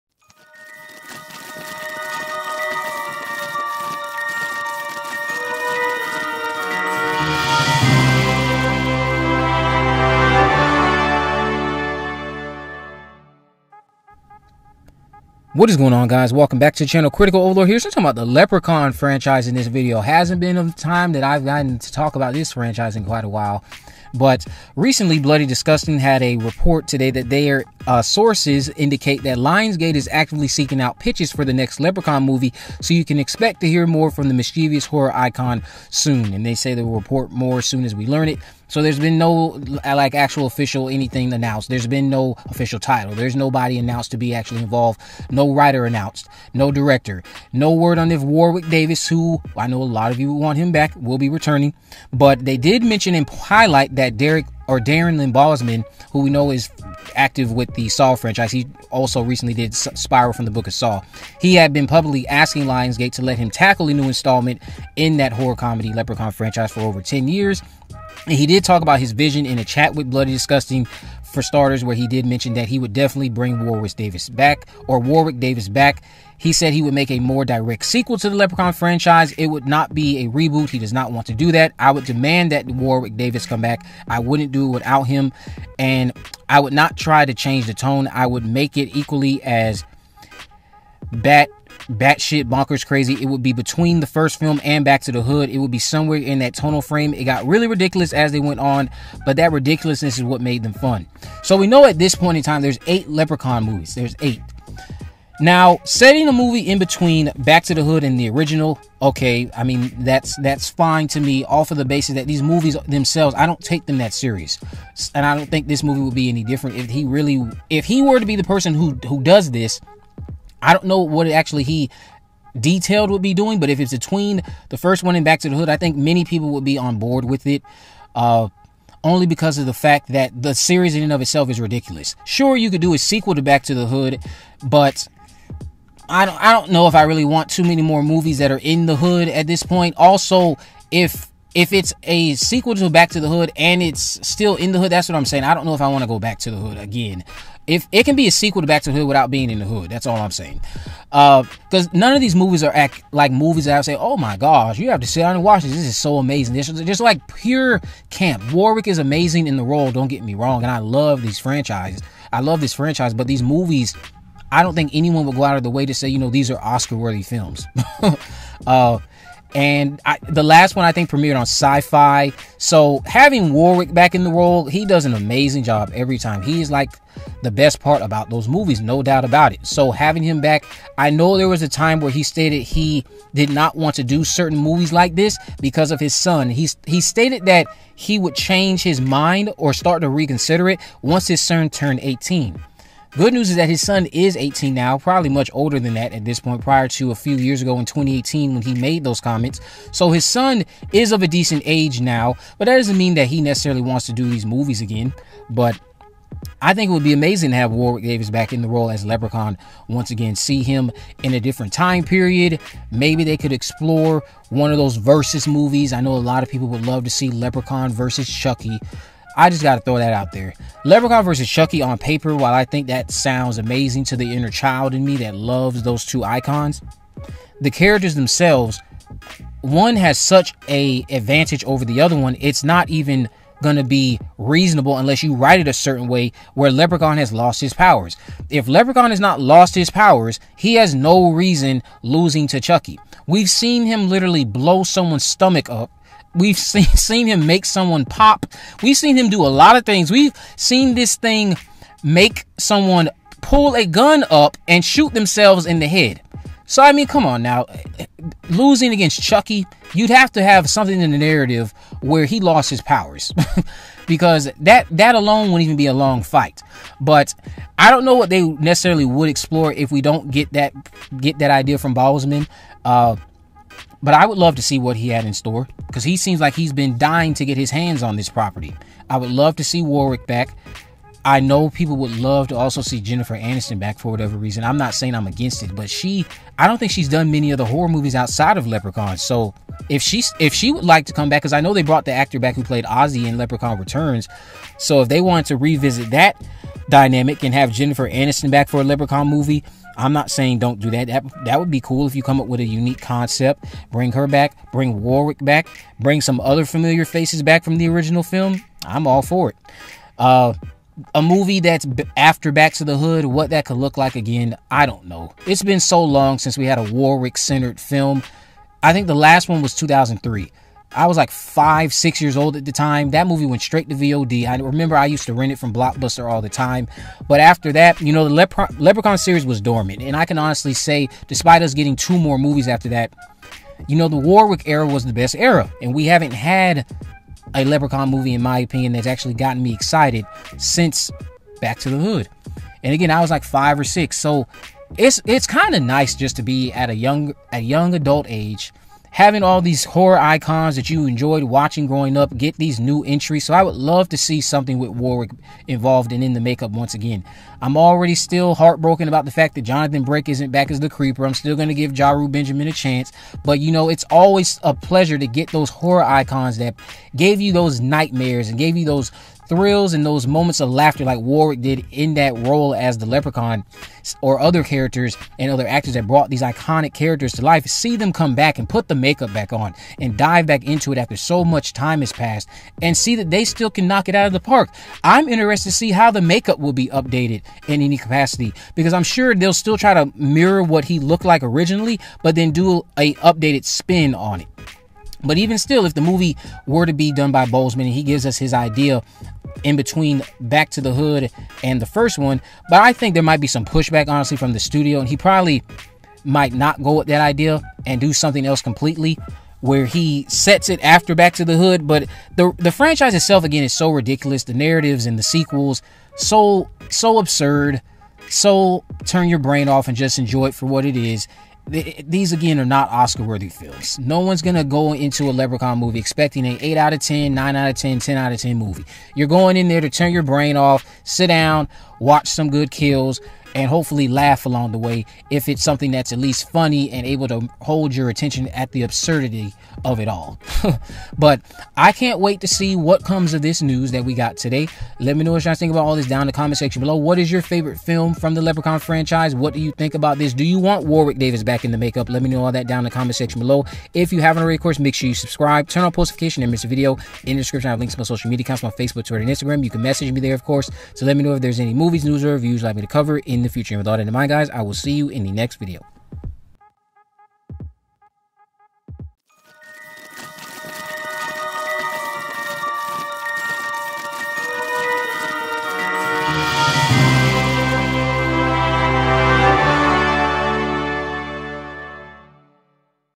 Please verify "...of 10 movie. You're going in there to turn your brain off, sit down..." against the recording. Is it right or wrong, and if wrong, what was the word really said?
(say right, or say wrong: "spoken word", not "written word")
right.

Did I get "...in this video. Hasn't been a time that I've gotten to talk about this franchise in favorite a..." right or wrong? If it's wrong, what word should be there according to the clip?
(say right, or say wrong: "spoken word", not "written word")
wrong: "quite", not "favorite".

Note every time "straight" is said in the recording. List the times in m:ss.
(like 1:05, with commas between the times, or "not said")
5:23.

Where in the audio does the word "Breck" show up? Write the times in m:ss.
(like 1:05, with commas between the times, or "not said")
6:00.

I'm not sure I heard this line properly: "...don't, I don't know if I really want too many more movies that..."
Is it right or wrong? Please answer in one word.
right.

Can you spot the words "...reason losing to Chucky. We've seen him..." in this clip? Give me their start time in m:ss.
4:01.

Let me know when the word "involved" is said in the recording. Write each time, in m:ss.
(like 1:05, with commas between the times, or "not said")
0:44, 5:55.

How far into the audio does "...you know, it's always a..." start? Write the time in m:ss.
6:03.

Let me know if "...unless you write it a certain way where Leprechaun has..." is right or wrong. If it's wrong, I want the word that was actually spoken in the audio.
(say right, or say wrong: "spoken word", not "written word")
right.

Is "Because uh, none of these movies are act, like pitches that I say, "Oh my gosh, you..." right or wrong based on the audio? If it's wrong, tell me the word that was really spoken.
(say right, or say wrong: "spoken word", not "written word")
wrong: "movies", not "pitches".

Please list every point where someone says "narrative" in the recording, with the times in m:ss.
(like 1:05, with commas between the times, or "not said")
4:21, 6:54.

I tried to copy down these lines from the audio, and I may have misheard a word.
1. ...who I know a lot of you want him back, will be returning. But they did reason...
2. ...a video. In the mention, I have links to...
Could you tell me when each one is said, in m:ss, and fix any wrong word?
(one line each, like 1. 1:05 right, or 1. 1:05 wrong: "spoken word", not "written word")
1. 0:49 wrong: "mention", not "reason"
2. 7:36 wrong: "description", not "mention".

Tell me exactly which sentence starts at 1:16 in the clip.
He said he would make a more direct sequel to the Leprechaun franchise.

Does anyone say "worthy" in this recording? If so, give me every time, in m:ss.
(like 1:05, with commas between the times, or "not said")
2:46, 7:03.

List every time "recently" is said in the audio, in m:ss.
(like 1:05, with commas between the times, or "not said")
0:24, 0:59.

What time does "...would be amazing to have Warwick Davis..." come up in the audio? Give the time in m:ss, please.
3:26.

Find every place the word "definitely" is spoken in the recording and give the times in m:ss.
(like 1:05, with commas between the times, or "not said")
1:12.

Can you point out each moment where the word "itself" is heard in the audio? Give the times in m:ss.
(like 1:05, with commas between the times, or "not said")
2:11, 6:53.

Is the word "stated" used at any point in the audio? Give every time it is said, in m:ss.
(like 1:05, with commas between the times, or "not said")
3:02, 3:07.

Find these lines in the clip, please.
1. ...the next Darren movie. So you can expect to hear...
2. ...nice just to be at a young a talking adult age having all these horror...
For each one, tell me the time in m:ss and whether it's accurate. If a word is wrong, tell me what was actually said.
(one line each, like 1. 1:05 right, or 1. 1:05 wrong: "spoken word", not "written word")
1. 0:31 wrong: "Leprechaun", not "Darren"
2. 5:45 wrong: "young", not "talking".